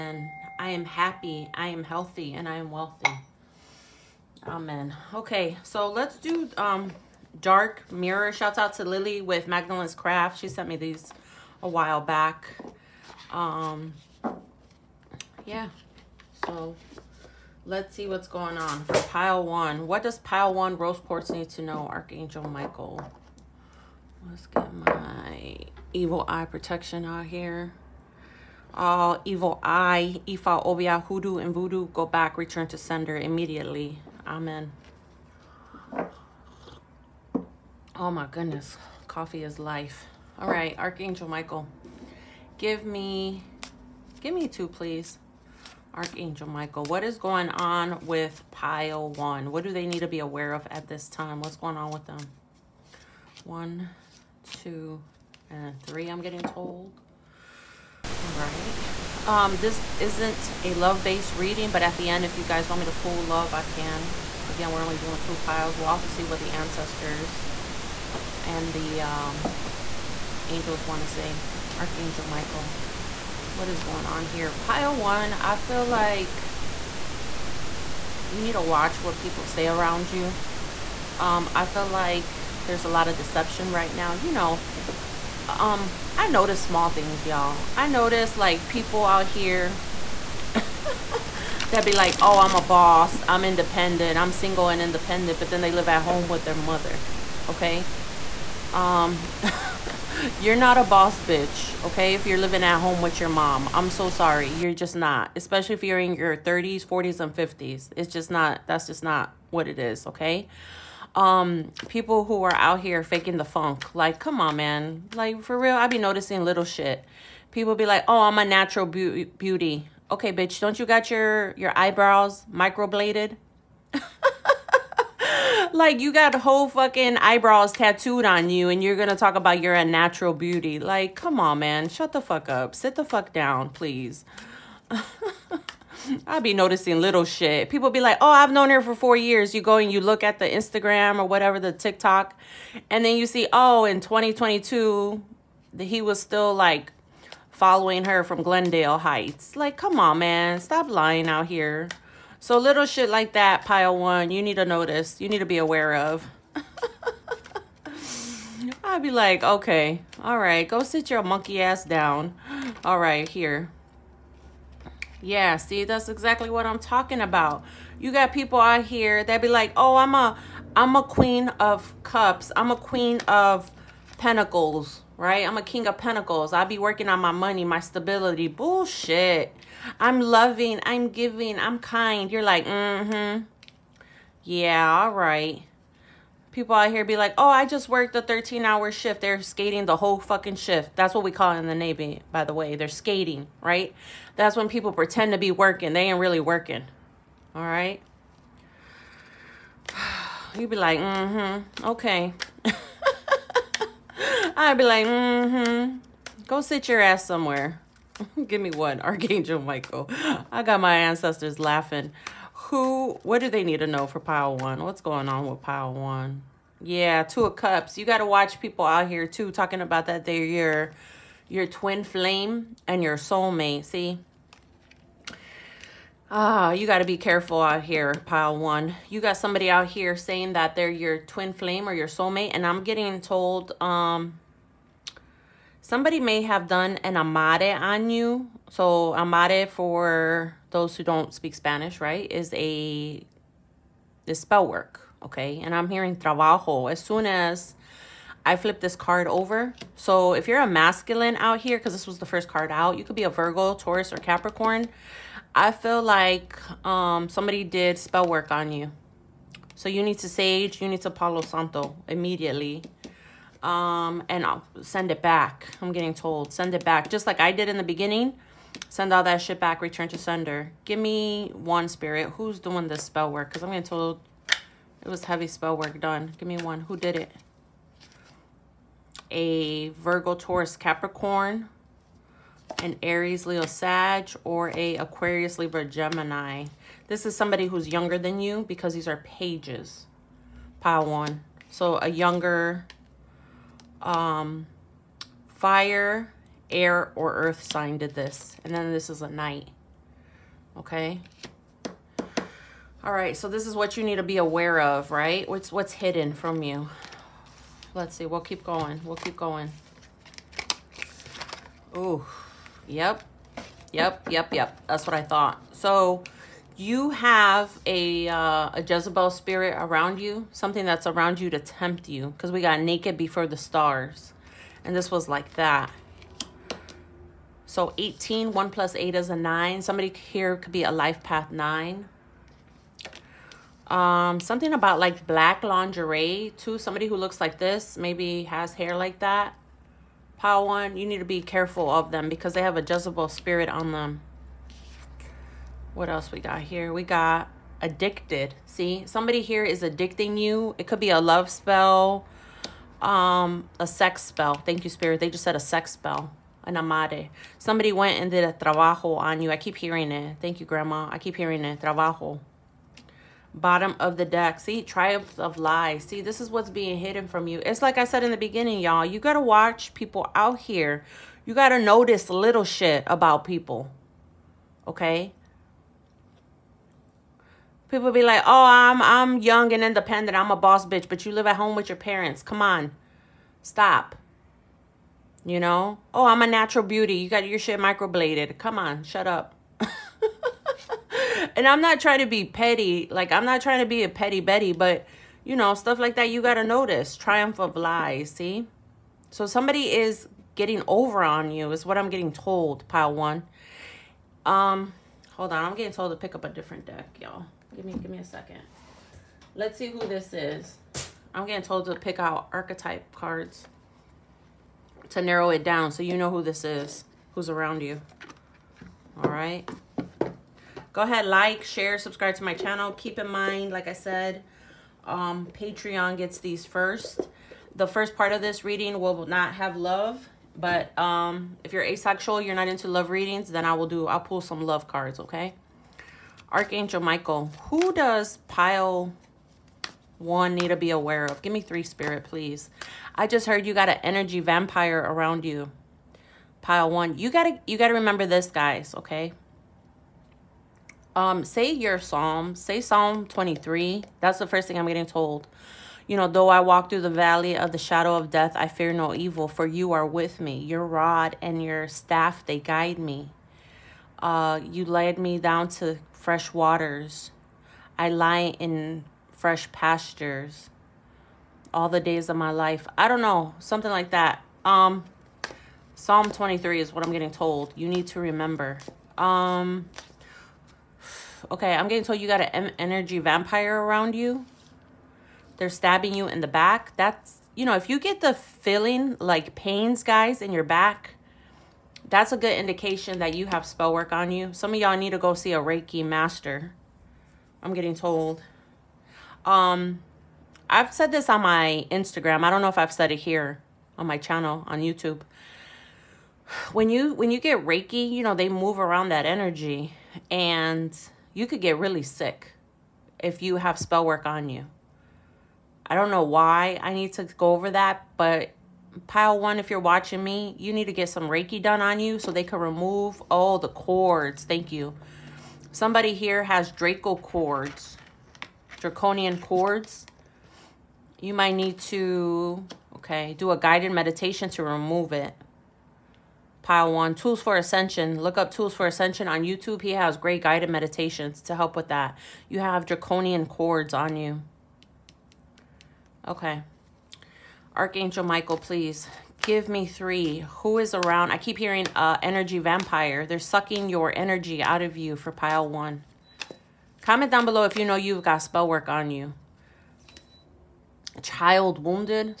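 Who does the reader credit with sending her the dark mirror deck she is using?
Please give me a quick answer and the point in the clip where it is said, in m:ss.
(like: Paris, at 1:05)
Lily, at 0:08.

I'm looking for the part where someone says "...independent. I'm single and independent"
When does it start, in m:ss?
1:33.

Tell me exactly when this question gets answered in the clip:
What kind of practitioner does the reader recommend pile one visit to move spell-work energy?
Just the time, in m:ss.
8:15.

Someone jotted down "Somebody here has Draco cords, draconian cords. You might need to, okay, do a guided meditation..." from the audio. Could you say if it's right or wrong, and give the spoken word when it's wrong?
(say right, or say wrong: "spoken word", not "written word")
right.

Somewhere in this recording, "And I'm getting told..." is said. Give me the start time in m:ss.
3:52.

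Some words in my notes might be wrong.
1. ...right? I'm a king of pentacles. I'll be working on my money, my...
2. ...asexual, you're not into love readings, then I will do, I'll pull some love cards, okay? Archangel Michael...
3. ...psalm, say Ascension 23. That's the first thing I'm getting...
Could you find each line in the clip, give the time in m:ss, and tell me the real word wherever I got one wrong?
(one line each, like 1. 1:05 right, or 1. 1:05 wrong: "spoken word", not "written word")
1. 2:55 right
2. 7:11 right
3. 7:31 wrong: "Psalm", not "Ascension".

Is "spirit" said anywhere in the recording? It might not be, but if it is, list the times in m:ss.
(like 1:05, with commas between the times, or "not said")
4:31, 5:19, 5:43, 5:54, 7:21.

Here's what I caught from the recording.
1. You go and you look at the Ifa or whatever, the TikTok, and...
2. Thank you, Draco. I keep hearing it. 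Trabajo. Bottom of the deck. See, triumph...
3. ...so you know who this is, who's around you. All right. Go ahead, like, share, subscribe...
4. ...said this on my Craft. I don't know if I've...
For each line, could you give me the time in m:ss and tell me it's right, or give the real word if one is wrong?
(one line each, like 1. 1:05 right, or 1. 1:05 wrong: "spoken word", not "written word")
1. 2:19 wrong: "Instagram", not "Ifa"
2. 6:00 wrong: "Grandma", not "Draco"
3. 6:55 right
4. 8:20 wrong: "Instagram", not "Craft".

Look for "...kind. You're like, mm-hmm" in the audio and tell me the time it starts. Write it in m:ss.
3:01.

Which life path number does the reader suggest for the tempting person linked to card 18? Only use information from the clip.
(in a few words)
9.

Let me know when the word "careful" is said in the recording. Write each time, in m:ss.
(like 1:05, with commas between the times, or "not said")
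3:47, 5:41.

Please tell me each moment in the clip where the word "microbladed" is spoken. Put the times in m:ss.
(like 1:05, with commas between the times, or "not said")
2:02, 6:27.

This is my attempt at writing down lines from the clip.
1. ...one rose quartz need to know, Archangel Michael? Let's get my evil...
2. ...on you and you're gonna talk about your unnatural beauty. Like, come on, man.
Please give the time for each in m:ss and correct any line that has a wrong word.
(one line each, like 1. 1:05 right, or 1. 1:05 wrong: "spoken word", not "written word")
1. 0:20 right
2. 2:08 right.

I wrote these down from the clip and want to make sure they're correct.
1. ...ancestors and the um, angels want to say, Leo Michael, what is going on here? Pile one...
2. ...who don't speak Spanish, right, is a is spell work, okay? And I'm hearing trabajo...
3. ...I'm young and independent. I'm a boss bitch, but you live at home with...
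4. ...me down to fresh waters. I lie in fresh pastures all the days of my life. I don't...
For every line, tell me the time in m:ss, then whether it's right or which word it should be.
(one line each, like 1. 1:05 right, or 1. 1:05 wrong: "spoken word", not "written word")
1. 1:06 wrong: "Archangel", not "Leo"
2. 4:00 right
3. 6:19 right
4. 7:45 right.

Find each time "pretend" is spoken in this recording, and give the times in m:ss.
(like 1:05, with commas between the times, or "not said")
3:14.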